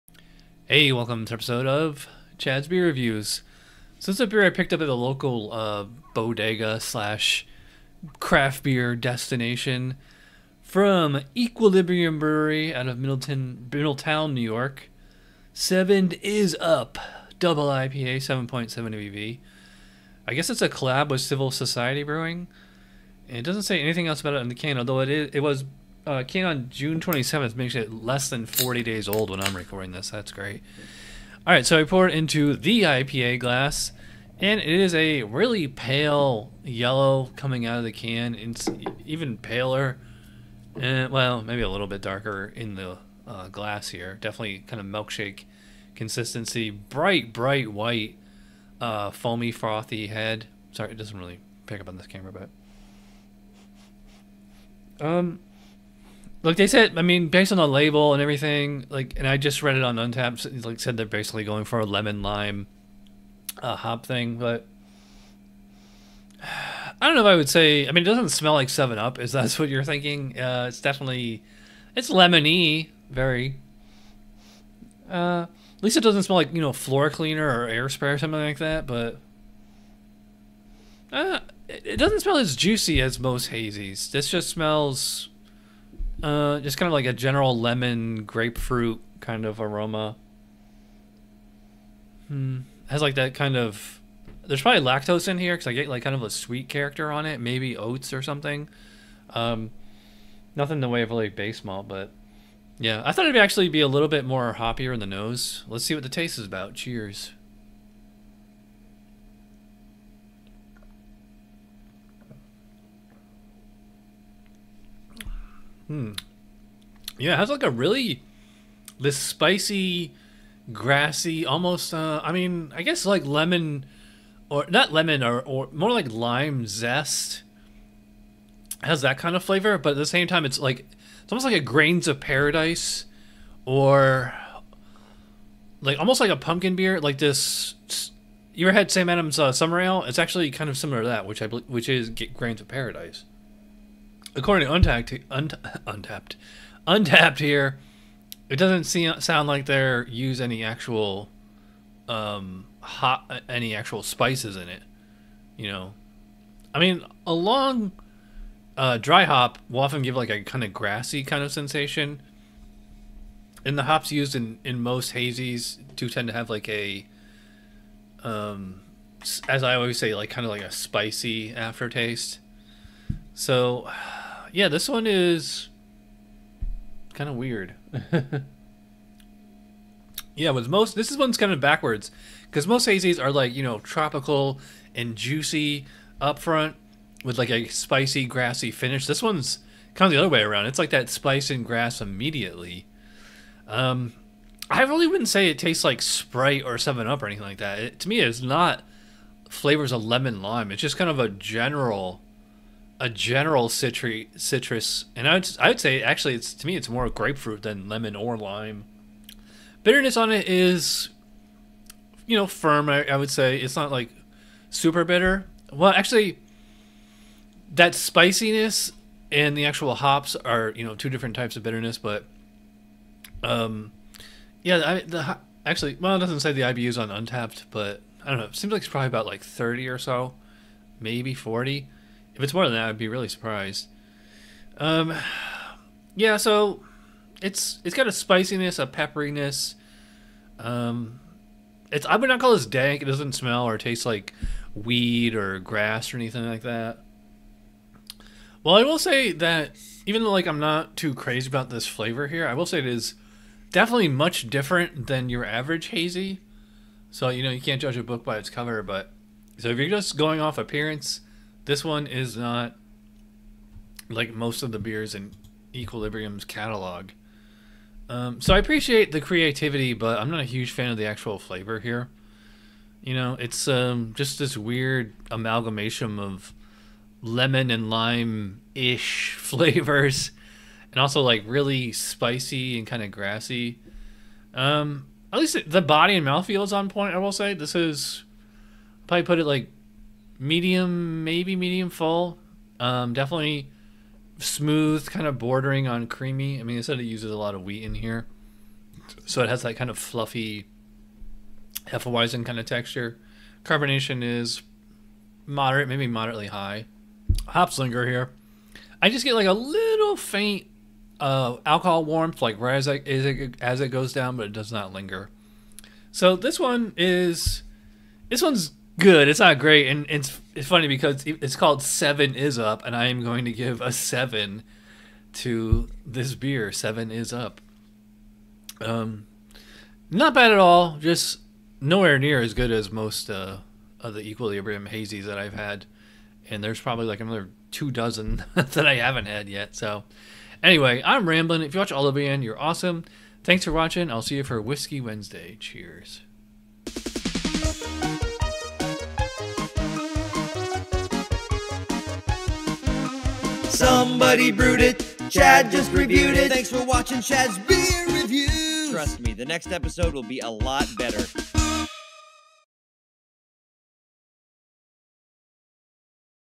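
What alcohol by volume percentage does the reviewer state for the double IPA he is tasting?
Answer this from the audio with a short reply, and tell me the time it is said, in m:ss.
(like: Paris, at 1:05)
7.7, at 0:18.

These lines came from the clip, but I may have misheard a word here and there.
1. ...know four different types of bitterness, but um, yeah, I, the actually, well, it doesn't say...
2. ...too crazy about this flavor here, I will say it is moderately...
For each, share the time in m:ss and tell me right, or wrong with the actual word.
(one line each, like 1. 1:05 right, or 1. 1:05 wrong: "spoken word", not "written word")
1. 3:40 wrong: "two", not "four"
2. 4:10 wrong: "definitely", not "moderately".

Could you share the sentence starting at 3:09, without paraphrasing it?
This one's kind of the other way around.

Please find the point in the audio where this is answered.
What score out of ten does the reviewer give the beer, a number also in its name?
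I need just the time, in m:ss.
5:23.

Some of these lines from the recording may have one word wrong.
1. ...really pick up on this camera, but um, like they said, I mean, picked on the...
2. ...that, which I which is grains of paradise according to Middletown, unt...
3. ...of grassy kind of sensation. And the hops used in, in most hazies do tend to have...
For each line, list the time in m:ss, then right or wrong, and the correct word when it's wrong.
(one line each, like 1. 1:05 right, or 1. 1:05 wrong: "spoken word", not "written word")
1. 0:51 wrong: "based", not "picked"
2. 2:21 wrong: "Untappd", not "Middletown"
3. 2:40 right.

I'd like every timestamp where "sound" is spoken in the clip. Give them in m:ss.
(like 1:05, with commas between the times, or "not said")
2:29.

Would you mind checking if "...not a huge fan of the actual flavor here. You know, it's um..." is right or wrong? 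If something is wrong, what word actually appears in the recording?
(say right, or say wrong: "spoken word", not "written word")
right.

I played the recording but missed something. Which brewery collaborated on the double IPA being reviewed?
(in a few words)
Civil Society Brewing.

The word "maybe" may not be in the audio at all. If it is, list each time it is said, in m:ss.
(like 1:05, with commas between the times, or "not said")
0:41, 1:37, 3:50, 4:51, 5:05.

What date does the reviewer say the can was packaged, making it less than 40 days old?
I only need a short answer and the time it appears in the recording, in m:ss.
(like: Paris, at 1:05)
June 27th, at 0:26.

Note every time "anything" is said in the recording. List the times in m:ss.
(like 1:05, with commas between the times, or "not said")
0:23, 3:17, 4:06.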